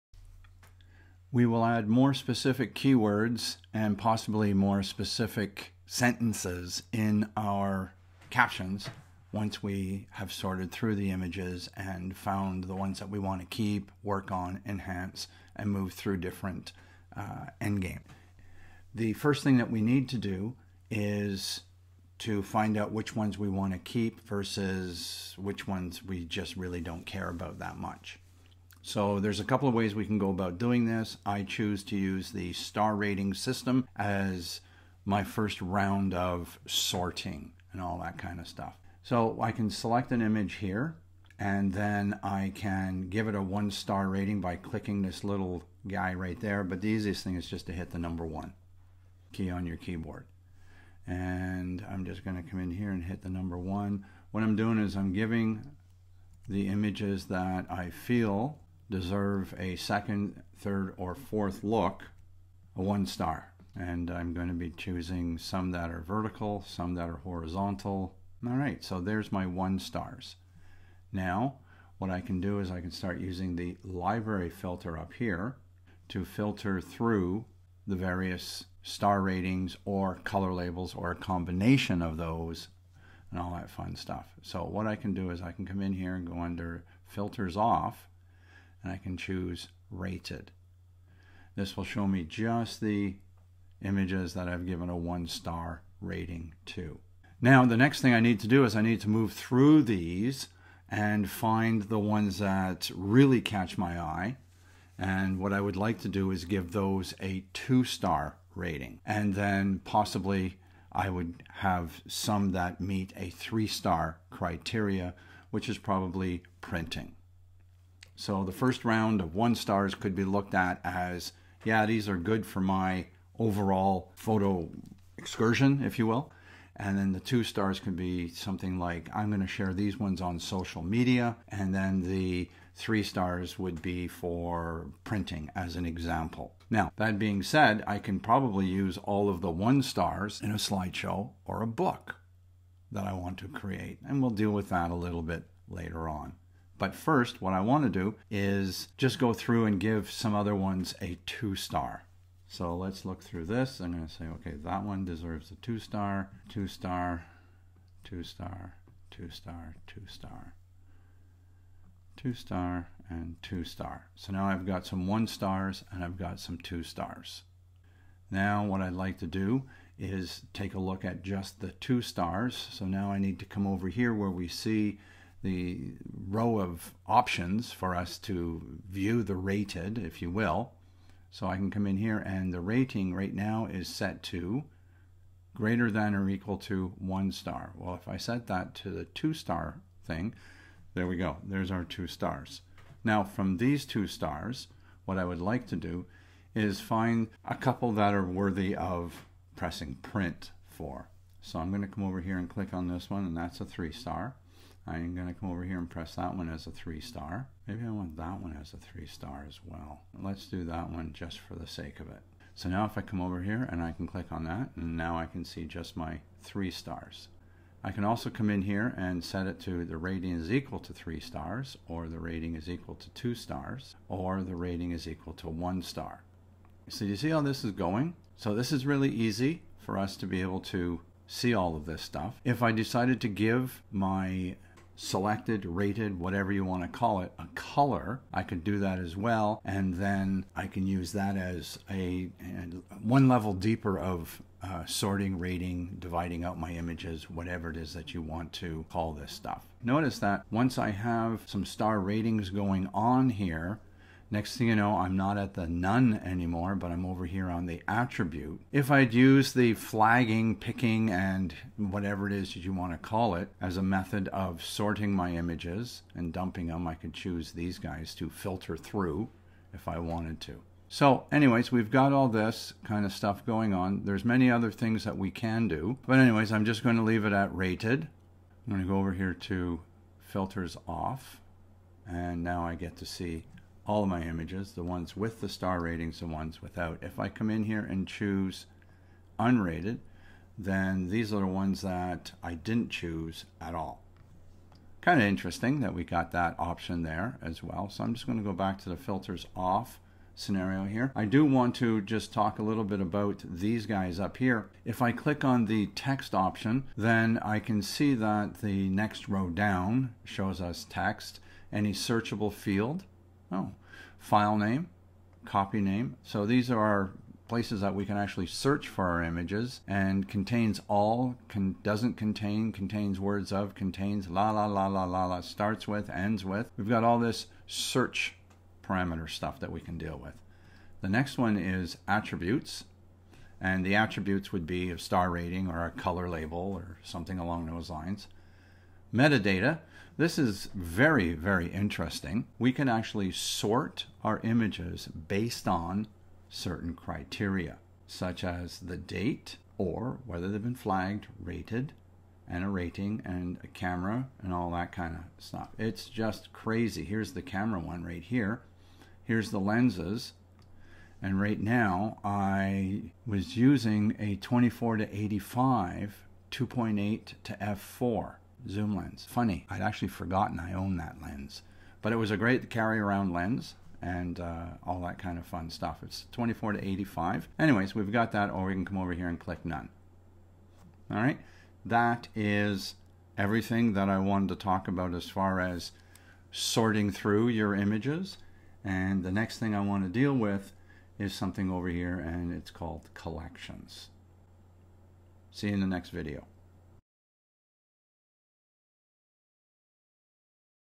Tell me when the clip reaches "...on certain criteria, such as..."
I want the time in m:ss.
5:45.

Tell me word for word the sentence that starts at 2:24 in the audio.
And we'll deal with that a little bit later on.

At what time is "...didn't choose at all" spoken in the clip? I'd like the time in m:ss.
4:52.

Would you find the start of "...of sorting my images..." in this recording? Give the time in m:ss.
4:24.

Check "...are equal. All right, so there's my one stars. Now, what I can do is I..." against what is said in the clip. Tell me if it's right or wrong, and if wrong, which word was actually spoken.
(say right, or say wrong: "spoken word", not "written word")
wrong: "horizontal", not "equal".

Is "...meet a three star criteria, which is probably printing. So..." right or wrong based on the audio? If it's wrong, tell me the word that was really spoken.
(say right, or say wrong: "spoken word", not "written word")
right.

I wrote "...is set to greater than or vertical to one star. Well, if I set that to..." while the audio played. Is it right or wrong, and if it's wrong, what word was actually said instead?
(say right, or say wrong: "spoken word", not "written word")
wrong: "equal", not "vertical".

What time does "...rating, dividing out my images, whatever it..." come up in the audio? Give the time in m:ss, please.
4:05.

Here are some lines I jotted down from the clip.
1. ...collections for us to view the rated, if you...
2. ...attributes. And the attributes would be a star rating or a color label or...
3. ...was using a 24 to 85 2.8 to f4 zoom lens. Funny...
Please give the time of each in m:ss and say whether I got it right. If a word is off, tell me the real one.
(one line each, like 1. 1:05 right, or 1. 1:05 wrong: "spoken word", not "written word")
1. 2:57 wrong: "options", not "collections"
2. 5:32 right
3. 6:03 right.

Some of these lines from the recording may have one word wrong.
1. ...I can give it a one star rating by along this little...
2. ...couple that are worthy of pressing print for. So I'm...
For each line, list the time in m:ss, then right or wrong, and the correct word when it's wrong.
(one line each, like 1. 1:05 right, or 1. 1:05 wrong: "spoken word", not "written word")
1. 0:42 wrong: "clicking", not "along"
2. 3:17 right.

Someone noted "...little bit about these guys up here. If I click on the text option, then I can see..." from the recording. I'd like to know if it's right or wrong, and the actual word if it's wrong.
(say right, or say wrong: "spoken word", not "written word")
right.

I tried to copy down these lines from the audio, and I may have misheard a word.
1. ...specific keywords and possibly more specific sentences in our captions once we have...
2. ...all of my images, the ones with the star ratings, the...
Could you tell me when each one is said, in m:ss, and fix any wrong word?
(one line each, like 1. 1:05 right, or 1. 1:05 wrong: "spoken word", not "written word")
1. 0:02 right
2. 4:43 right.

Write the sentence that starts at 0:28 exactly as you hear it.
So there's a couple of ways we can go about doing this.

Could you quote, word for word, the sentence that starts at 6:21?
All right, that is everything that I wanted to talk about as far as sorting through your images.